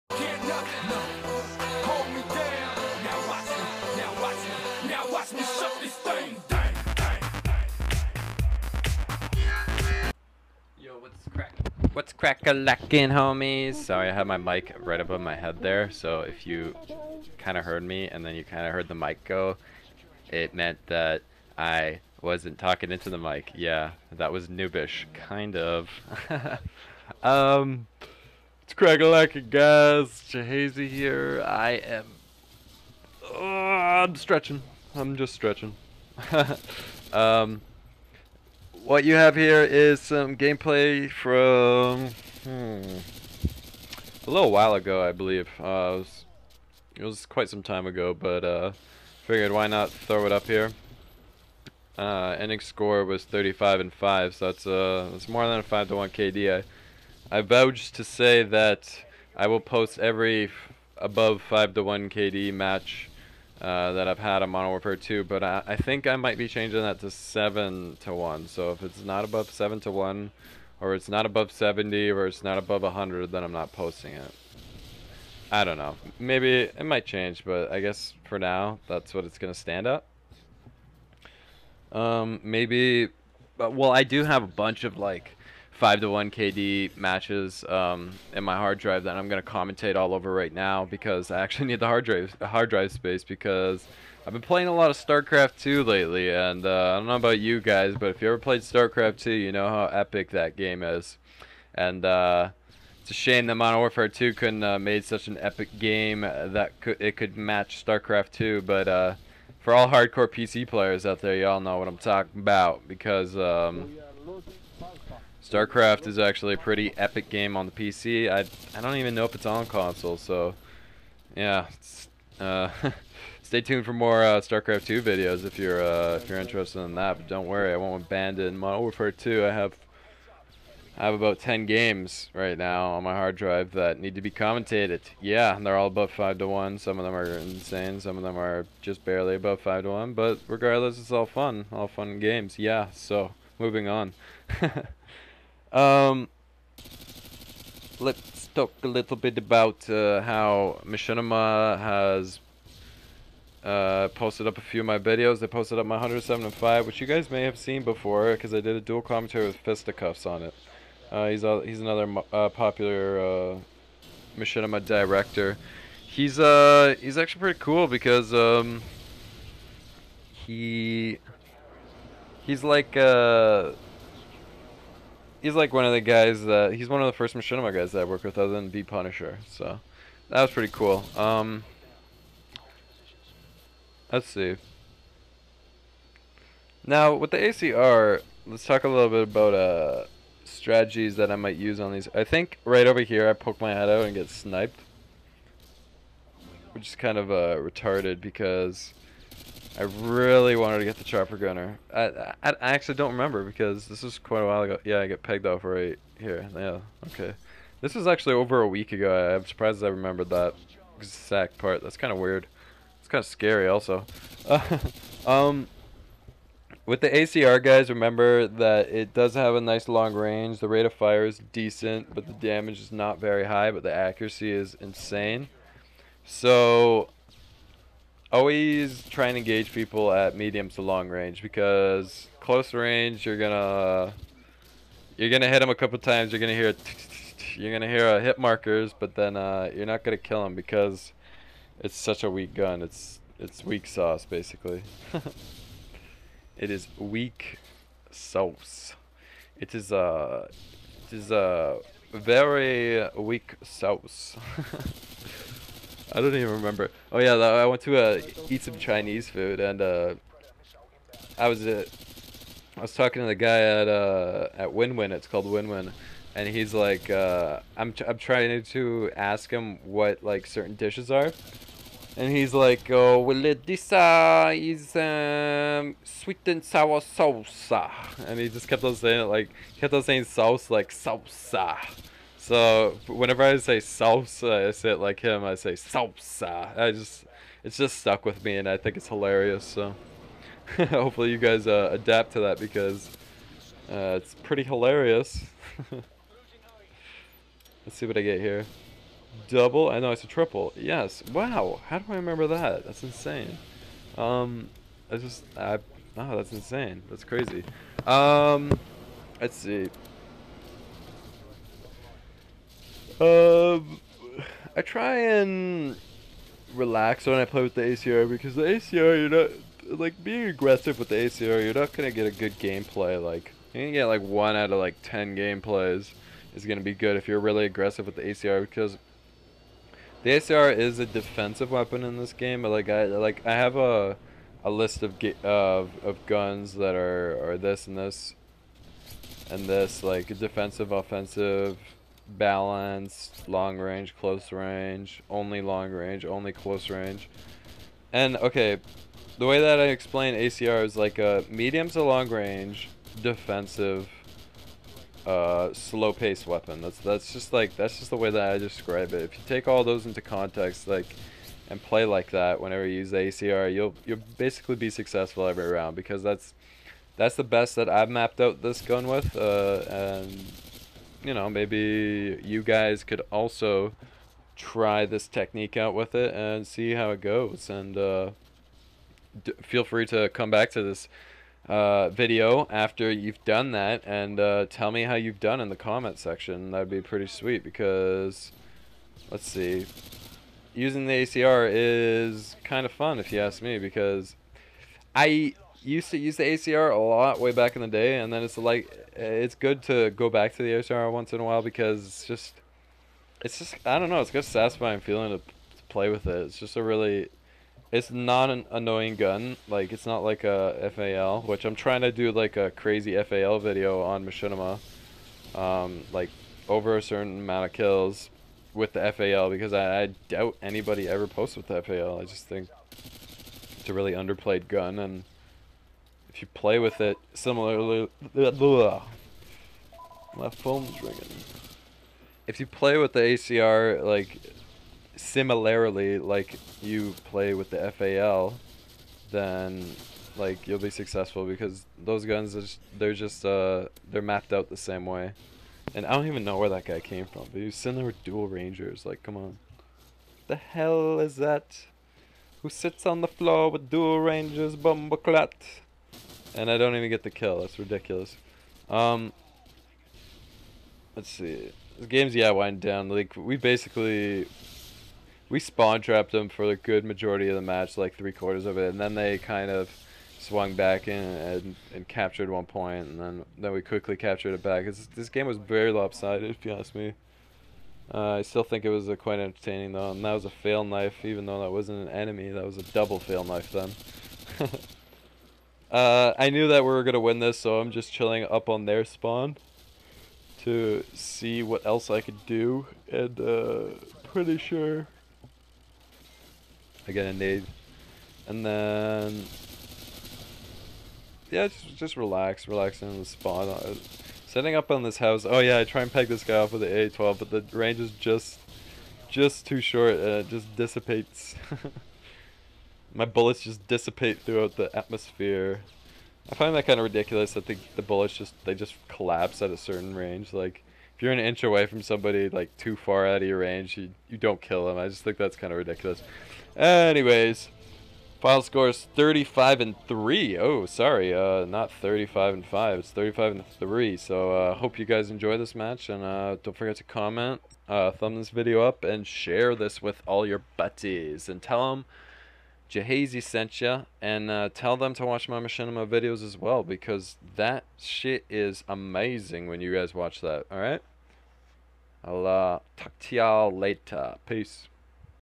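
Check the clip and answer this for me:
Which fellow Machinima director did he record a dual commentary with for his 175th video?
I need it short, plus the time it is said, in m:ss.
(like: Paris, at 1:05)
FistDaCuffs, at 2:39.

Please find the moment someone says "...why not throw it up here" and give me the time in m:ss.
0:49.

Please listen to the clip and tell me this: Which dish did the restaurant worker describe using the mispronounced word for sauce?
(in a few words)
sweet and sour salsa.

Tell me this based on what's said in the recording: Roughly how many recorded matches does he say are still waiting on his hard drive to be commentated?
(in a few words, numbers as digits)
10.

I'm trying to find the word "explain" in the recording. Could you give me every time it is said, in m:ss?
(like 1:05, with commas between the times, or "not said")
5:49.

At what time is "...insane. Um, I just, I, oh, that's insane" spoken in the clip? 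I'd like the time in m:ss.
5:03.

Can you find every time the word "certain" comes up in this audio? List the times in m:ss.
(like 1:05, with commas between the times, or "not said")
4:30, 6:57, 8:39.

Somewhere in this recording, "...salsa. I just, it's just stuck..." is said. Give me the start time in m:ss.
4:45.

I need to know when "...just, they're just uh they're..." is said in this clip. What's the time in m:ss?
7:22.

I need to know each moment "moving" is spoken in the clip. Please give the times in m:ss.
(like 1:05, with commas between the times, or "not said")
2:23.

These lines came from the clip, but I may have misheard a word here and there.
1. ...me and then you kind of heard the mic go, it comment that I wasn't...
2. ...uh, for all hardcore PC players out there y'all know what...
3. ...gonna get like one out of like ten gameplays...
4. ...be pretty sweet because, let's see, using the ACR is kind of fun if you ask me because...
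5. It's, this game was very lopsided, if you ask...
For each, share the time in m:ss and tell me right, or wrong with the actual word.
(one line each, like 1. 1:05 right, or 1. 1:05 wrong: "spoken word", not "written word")
1. 0:17 wrong: "meant", not "comment"
2. 1:48 right
3. 5:23 right
4. 6:26 right
5. 7:54 right.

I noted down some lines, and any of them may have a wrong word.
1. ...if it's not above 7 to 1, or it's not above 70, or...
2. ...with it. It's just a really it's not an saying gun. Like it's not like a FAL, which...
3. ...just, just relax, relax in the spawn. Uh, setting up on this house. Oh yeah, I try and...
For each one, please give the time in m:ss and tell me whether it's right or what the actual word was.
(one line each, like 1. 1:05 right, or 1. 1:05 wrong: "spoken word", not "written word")
1. 1:08 right
2. 6:46 wrong: "annoying", not "saying"
3. 8:21 right.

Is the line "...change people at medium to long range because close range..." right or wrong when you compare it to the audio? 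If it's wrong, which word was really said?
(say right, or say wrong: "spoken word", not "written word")
wrong: "engage", not "change".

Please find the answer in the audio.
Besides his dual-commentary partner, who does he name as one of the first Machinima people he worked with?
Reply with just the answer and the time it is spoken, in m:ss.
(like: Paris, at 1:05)
the Punisher, at 2:58.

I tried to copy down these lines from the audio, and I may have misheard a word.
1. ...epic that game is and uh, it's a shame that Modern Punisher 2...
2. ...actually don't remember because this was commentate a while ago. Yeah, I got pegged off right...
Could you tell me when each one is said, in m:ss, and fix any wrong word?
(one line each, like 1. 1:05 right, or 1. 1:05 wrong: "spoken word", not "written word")
1. 1:39 wrong: "Warfare", not "Punisher"
2. 3:22 wrong: "quite", not "commentate".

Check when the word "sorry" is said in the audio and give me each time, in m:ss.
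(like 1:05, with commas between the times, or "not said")
0:13, 8:50.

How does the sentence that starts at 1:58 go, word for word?
I, I don't even know if it's on console, so yeah.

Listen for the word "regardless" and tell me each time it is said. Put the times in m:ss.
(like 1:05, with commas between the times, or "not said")
2:20.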